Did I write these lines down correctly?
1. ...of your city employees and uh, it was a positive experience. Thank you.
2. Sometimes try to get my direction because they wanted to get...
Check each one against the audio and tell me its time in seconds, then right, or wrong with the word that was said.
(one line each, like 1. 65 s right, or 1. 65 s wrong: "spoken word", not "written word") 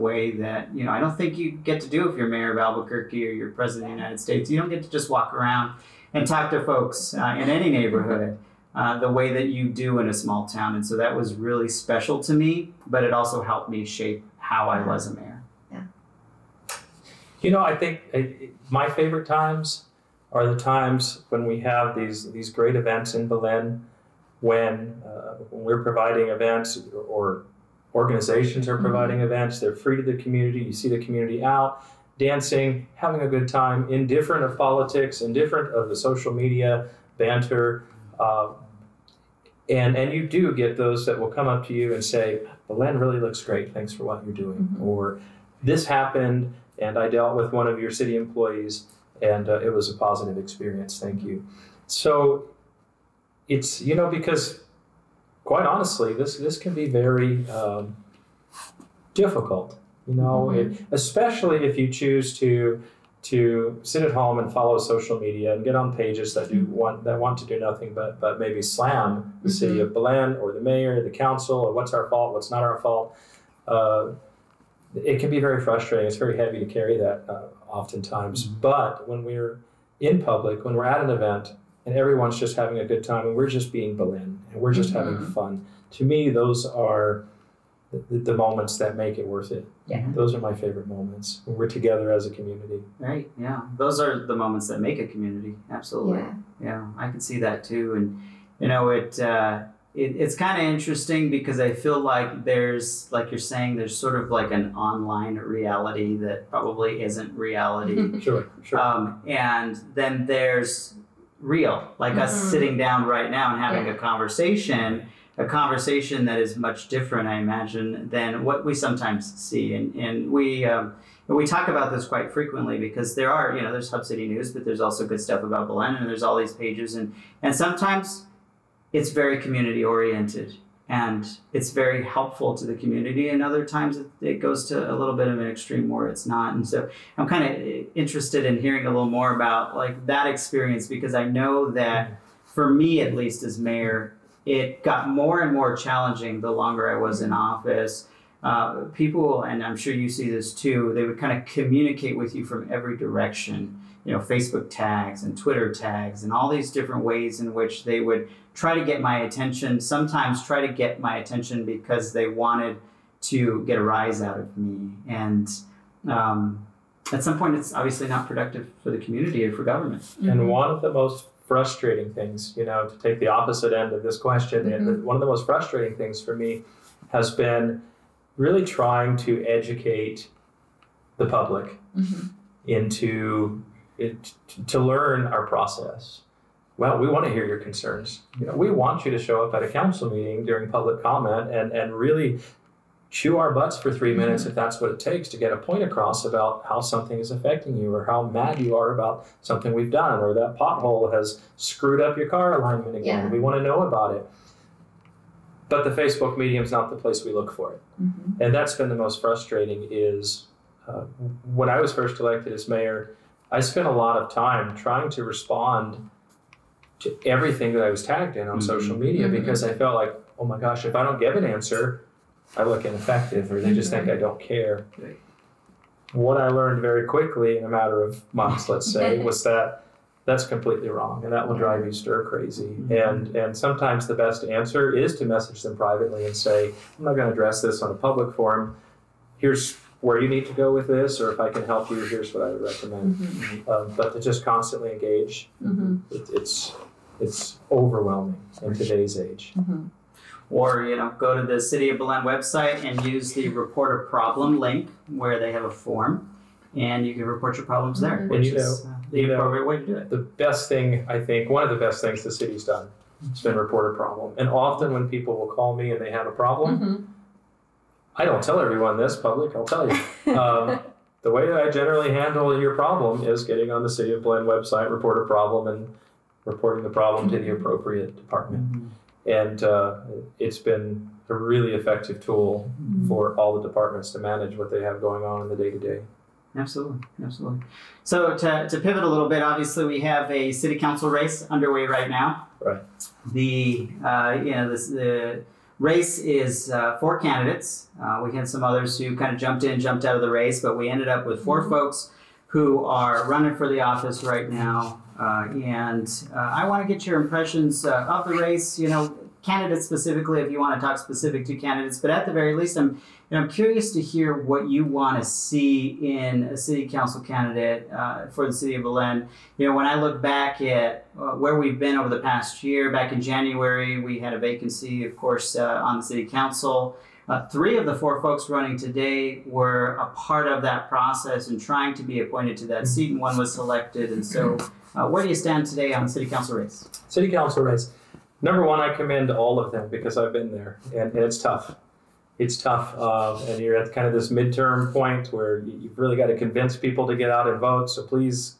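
1. 47 s right
2. 159 s wrong: "attention", not "direction".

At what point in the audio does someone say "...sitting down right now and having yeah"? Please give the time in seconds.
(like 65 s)
112 s.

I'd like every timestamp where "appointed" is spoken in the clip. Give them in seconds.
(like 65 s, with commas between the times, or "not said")
332 s.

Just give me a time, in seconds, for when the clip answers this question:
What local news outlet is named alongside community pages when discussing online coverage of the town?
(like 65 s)
123 s.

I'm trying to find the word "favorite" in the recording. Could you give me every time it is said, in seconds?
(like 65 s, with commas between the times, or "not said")
18 s, 90 s.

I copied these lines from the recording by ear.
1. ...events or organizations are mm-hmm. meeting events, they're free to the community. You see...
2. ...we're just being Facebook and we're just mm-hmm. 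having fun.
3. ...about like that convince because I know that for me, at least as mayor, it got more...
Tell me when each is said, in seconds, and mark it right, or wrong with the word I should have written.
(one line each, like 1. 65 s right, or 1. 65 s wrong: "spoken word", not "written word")
1. 26 s wrong: "providing", not "meeting"
2. 83 s wrong: "Belen", not "Facebook"
3. 139 s wrong: "experience", not "convince".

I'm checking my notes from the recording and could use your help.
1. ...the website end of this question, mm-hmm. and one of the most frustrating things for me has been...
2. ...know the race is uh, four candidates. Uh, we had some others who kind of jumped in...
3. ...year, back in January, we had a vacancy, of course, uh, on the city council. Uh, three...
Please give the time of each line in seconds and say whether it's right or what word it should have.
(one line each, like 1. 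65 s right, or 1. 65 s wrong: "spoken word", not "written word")
1. 173 s wrong: "opposite", not "website"
2. 294 s right
3. 322 s right.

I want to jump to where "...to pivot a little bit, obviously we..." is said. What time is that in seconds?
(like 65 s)
288 s.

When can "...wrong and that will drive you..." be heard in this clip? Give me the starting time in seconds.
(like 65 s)
230 s.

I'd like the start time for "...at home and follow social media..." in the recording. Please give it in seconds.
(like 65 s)
64 s.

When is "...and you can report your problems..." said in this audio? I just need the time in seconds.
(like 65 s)
256 s.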